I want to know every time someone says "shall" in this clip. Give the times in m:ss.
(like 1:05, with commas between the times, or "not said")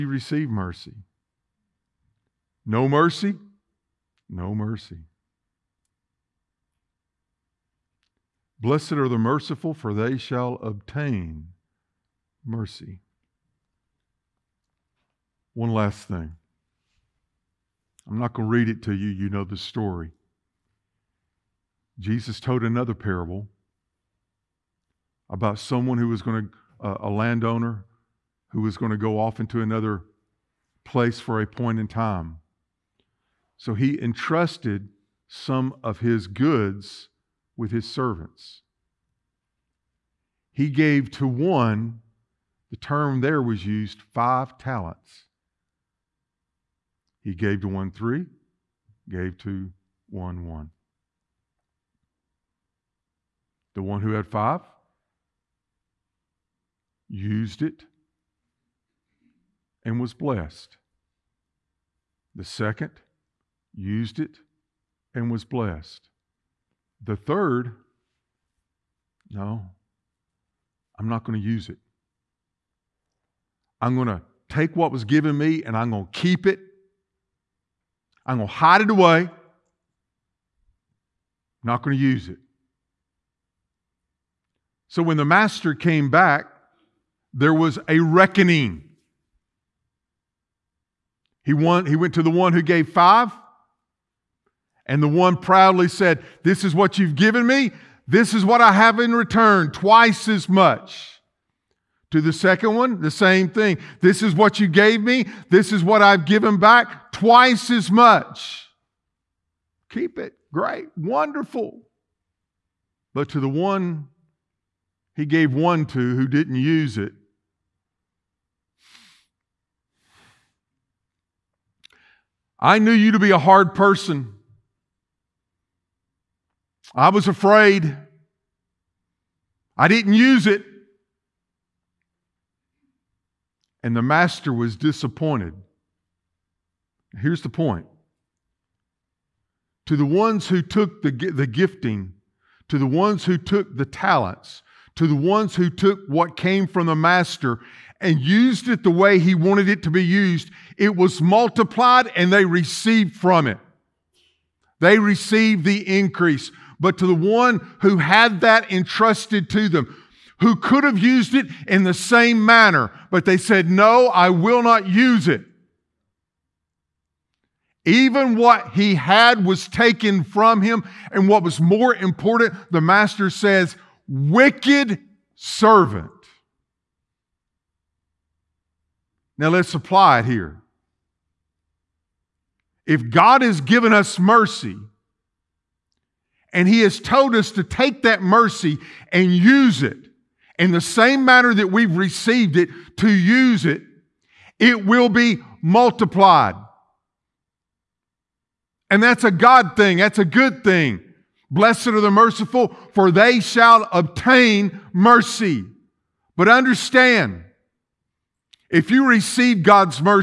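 0:10, 3:23.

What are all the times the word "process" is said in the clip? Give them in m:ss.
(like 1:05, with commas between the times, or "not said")
not said.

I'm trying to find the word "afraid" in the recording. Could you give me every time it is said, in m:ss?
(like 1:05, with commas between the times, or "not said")
2:07.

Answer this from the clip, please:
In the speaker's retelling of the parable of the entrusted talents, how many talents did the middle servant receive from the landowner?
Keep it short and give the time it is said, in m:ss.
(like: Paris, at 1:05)
3, at 0:47.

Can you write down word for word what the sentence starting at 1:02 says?
The second used it and was blessed.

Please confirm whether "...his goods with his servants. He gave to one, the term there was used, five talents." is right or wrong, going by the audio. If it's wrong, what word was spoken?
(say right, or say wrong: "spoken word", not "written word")
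right.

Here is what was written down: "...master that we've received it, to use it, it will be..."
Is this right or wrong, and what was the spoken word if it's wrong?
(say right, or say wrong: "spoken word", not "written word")
wrong: "manner", not "master".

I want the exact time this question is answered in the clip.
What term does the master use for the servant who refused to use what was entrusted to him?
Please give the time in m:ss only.
2:54.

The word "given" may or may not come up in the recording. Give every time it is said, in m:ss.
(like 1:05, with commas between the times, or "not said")
1:15, 1:37, 1:46, 3:03.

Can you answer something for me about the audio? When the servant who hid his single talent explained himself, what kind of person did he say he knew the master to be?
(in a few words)
A hard person.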